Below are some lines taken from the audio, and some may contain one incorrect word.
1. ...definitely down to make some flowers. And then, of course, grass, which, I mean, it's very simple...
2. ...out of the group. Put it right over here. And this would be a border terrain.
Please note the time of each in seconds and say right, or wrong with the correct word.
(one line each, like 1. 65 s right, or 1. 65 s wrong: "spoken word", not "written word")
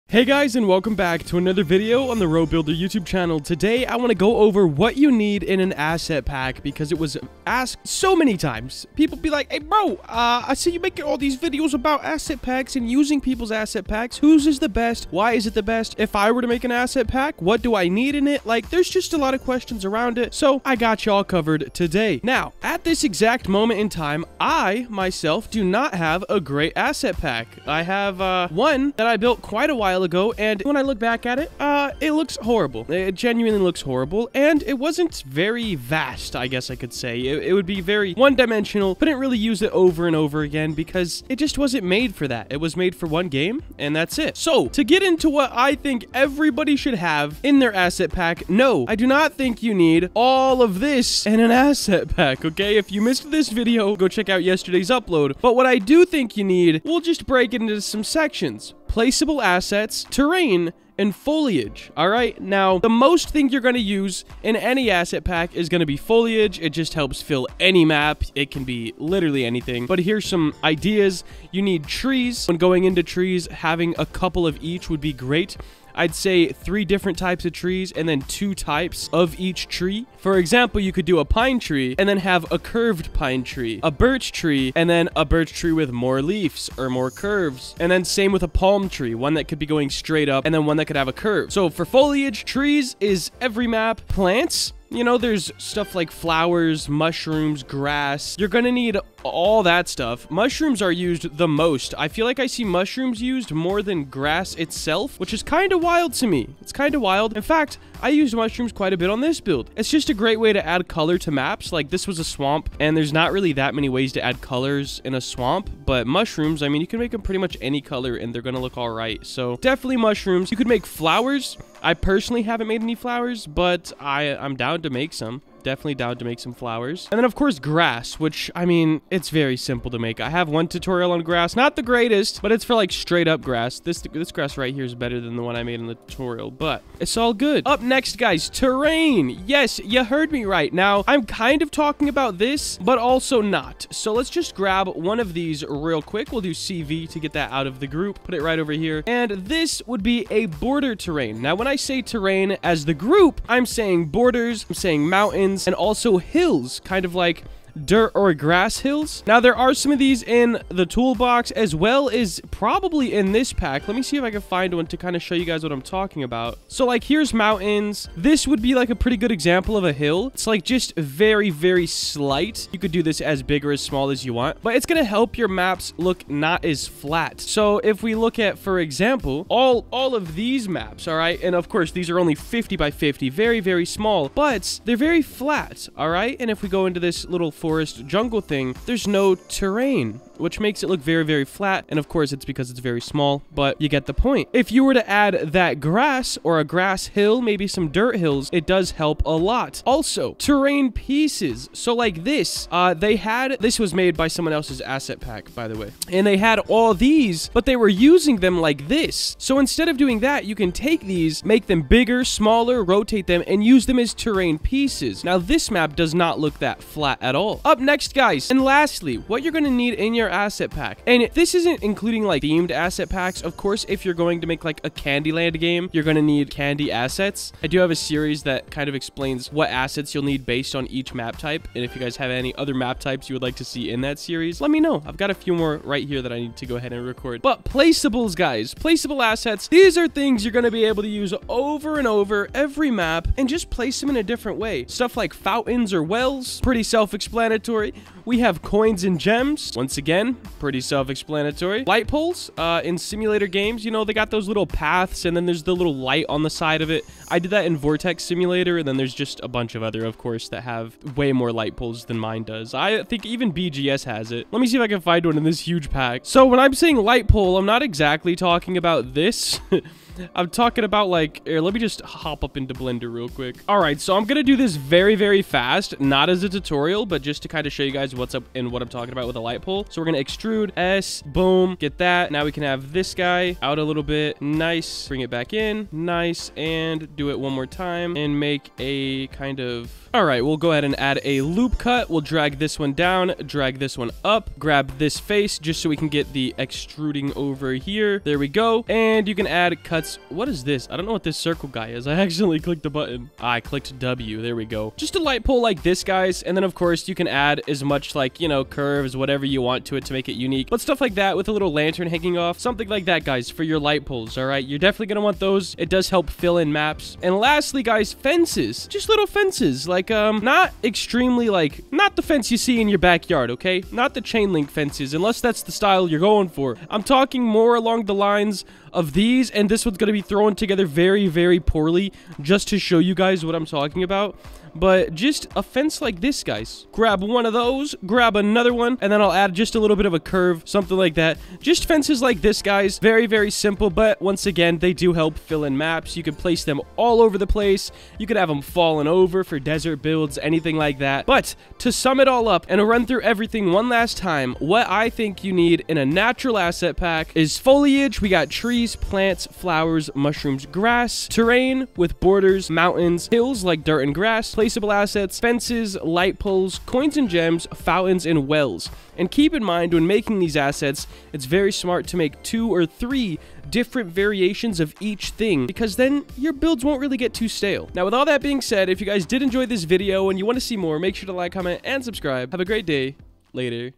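1. 125 s right
2. 147 s right.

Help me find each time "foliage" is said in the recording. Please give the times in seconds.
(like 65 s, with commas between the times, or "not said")
61 s, 65 s, 91 s, 357 s.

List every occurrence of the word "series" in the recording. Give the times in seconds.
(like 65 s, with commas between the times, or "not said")
227 s, 234 s.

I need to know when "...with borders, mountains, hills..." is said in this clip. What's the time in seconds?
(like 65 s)
361 s.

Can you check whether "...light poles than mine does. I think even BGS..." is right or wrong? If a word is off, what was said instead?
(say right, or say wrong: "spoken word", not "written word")
right.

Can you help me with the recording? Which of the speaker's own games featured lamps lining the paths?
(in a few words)
Vortex Simulator.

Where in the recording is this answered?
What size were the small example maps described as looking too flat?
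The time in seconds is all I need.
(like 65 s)
182 s.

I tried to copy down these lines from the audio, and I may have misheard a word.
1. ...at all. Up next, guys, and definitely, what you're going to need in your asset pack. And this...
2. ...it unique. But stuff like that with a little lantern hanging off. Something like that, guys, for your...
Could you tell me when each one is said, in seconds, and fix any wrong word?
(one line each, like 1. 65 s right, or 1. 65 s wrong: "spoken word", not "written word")
1. 217 s wrong: "lastly", not "definitely"
2. 310 s right.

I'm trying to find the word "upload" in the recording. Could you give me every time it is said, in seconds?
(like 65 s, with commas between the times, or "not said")
54 s.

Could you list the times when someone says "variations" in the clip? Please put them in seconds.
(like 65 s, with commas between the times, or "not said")
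374 s.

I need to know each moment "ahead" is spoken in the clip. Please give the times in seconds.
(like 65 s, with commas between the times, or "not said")
236 s, 290 s.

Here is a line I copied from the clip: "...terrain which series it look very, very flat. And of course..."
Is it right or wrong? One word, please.
wrong.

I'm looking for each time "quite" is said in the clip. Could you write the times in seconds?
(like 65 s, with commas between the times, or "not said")
29 s, 108 s.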